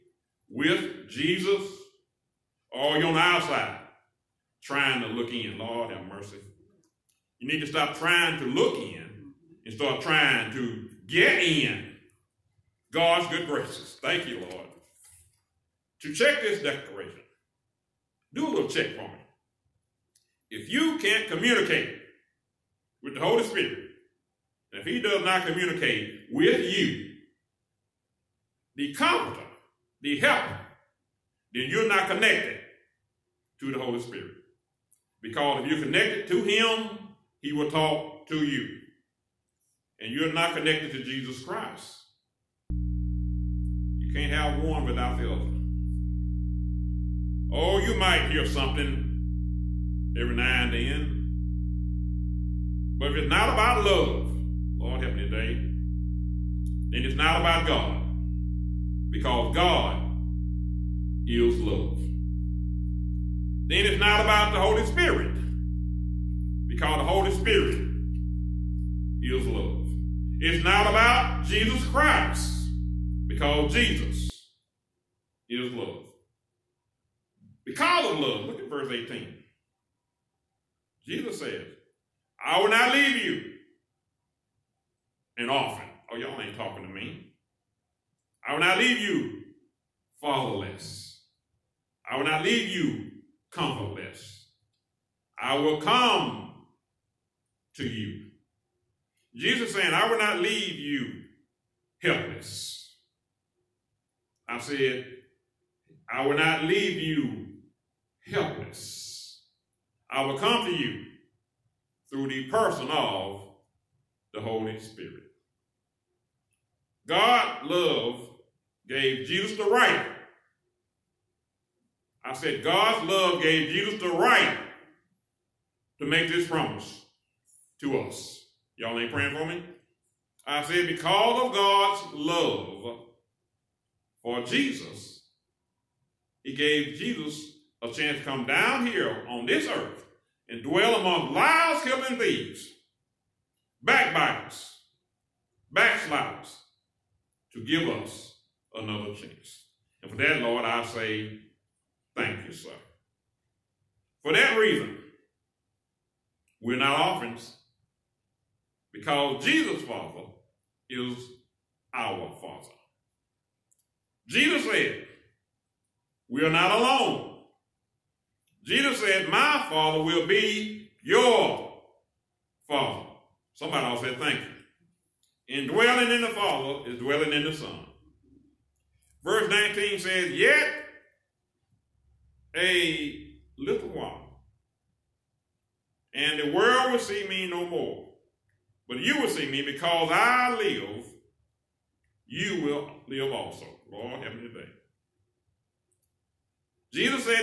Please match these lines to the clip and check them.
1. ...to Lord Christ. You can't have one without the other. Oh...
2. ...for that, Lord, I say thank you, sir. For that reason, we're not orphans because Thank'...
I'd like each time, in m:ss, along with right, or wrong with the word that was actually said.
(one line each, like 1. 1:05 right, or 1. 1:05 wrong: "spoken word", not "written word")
1. 0:40 wrong: "Jesus", not "Lord"
2. 2:30 wrong: "Jesus", not "Thank".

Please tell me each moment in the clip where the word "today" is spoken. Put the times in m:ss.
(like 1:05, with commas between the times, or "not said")
0:55, 3:14.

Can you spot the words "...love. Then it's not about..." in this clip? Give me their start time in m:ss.
1:01.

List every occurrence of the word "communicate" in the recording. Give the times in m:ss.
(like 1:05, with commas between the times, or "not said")
0:21, 0:25.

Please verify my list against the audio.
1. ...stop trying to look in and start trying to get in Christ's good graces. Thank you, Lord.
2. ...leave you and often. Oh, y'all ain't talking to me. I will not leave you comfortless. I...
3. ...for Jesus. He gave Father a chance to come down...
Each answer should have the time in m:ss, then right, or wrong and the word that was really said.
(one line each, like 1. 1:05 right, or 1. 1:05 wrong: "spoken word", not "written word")
1. 0:07 wrong: "God", not "Christ"
2. 1:22 wrong: "fatherless", not "comfortless"
3. 2:14 wrong: "Jesus", not "Father".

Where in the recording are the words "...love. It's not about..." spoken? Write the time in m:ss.
1:09.